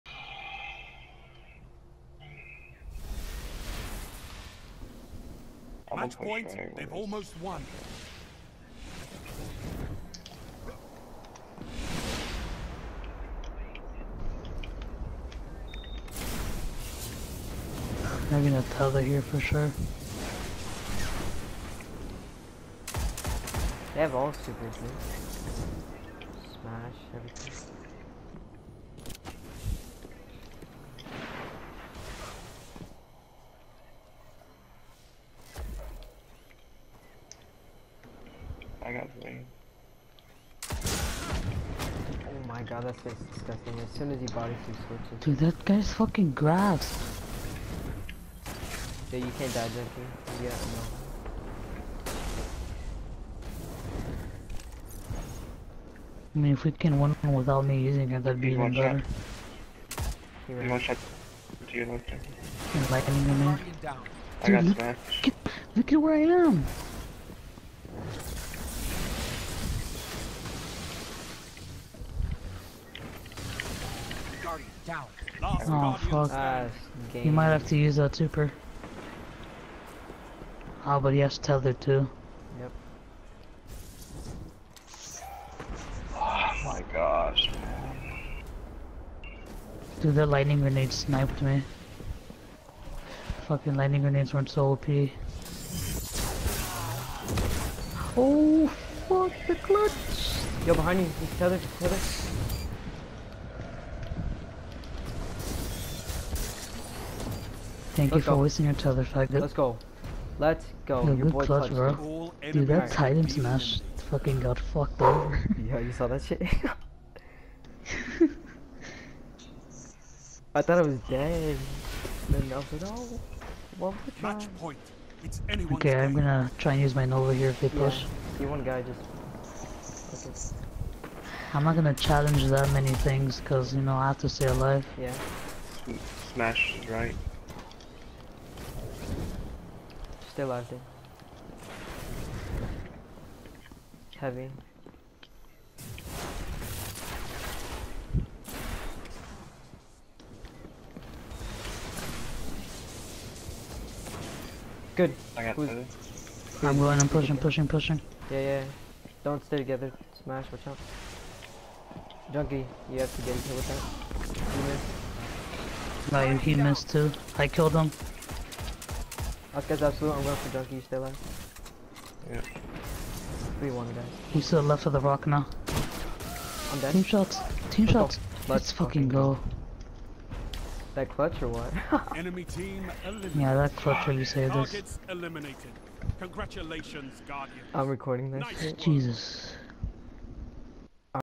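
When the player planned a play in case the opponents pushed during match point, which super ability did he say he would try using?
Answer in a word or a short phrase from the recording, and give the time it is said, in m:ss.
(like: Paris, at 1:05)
Nova, at 2:07.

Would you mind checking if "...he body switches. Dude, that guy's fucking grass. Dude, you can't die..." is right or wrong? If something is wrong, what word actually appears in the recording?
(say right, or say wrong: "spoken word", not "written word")
right.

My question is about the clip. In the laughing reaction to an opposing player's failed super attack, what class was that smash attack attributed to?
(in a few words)
Titan.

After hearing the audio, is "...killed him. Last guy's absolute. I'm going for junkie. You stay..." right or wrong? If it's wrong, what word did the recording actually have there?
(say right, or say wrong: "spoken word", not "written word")
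right.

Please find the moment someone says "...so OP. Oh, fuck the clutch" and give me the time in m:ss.
1:34.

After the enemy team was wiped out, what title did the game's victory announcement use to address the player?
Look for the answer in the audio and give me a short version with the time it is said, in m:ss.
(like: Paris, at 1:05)
Guardian, at 3:07.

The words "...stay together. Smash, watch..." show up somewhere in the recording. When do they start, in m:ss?
2:39.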